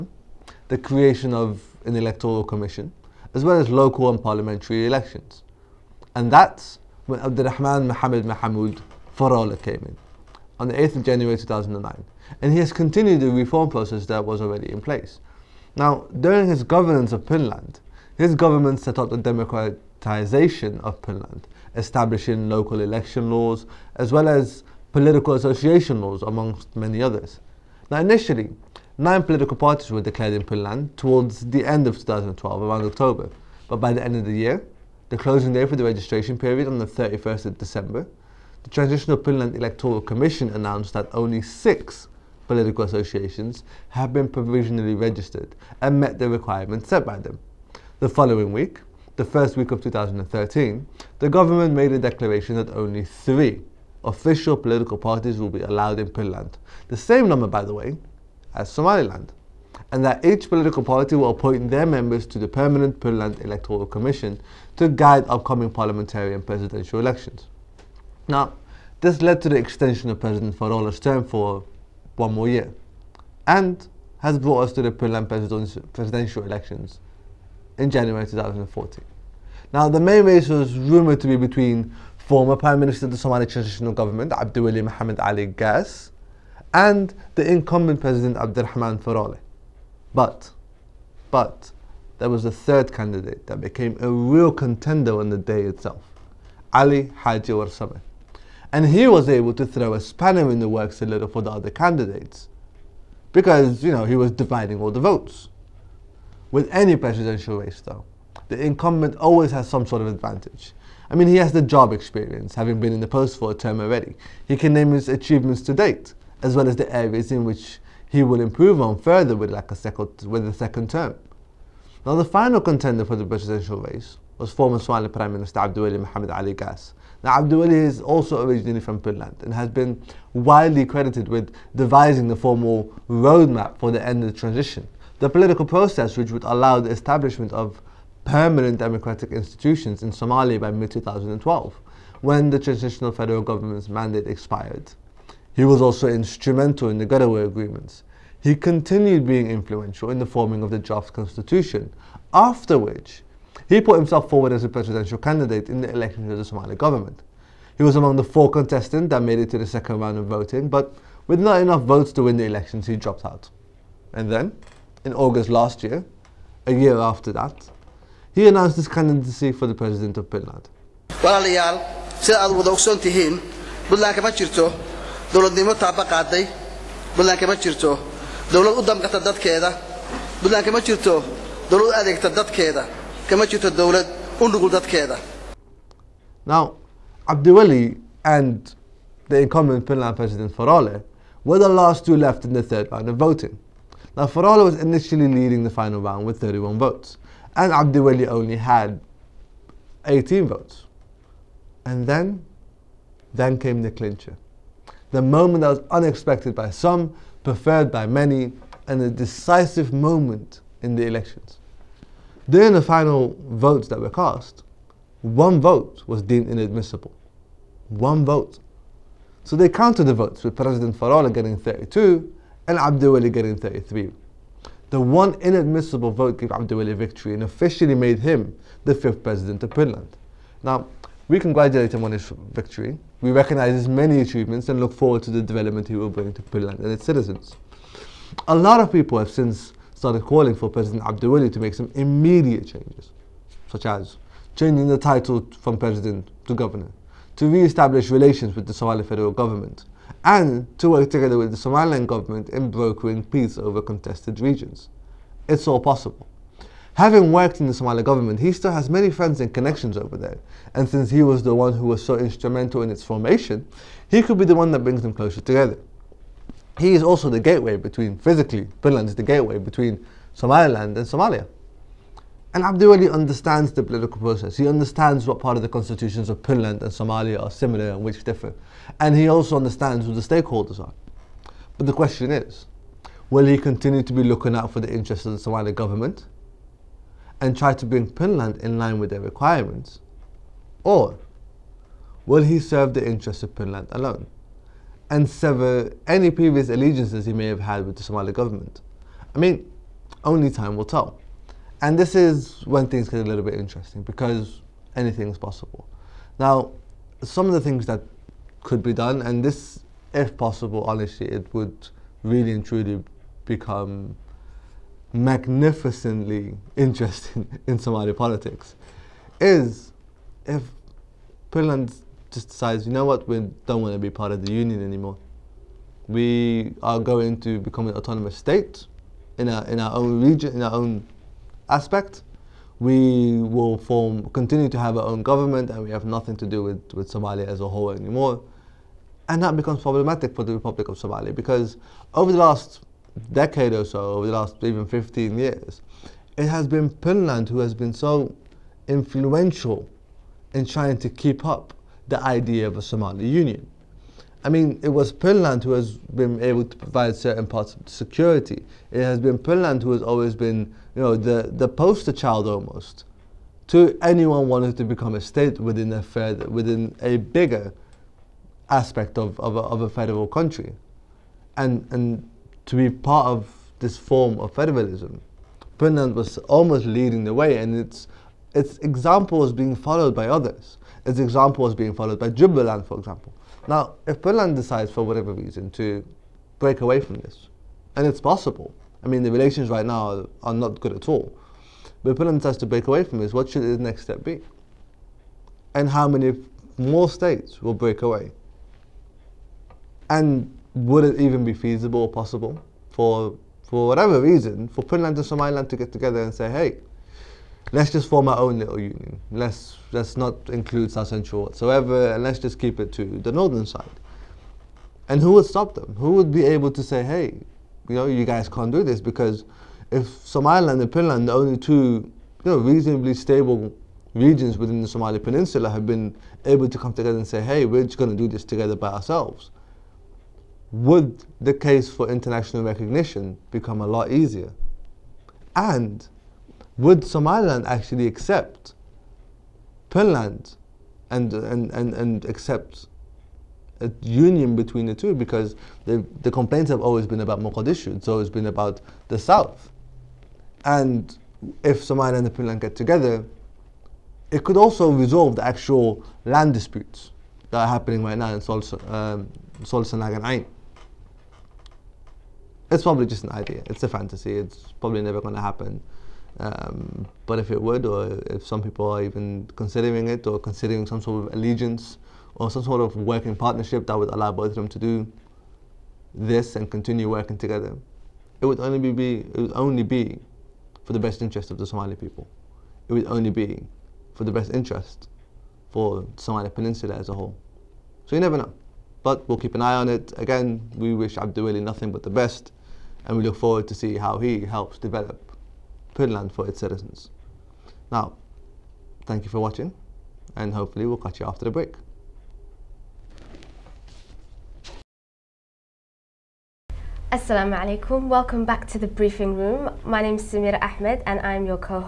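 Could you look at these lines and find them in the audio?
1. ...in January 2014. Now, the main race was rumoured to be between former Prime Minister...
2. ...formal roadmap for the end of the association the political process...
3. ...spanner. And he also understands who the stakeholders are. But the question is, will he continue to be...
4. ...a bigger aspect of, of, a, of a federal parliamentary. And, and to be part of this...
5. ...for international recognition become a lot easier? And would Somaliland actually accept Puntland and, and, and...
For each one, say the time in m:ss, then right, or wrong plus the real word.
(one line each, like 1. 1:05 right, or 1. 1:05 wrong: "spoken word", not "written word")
1. 1:17 right
2. 2:12 wrong: "transition", not "association"
3. 4:38 wrong: "differ", not "spanner"
4. 6:07 wrong: "country", not "parliamentary"
5. 7:11 right.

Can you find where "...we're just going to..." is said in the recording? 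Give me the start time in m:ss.
7:07.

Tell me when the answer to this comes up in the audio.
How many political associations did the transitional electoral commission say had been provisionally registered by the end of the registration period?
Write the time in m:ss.
0:41.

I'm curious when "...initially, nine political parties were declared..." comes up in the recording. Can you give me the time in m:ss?
0:27.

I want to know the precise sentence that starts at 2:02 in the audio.
Now, the final contender for the presidential race was former Somali Prime Minister Abdulwali Mohamed Ali Gaas.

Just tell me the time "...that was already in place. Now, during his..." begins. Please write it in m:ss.
0:14.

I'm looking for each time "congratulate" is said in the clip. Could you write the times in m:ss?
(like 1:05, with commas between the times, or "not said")
3:51.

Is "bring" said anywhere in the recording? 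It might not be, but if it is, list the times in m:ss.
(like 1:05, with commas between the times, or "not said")
3:56, 4:24, 4:47.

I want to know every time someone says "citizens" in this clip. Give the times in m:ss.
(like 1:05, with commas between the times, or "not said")
3:57, 8:16.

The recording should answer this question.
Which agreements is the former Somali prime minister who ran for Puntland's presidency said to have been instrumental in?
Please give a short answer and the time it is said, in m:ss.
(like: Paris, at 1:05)
Garowe Agreements, at 2:27.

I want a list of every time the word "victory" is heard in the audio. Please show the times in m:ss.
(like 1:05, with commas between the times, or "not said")
3:46, 3:52.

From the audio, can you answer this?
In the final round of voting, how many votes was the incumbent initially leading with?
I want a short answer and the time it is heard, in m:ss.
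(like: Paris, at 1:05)
31, at 3:16.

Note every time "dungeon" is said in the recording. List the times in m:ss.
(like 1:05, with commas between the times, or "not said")
not said.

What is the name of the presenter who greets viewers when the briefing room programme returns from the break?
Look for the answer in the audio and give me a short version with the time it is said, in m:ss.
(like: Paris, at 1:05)
Samira Ahmed, at 8:30.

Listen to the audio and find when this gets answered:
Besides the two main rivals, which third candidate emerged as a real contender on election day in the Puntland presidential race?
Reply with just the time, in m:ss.
1:36.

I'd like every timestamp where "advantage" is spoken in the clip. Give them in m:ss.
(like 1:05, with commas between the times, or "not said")
1:50.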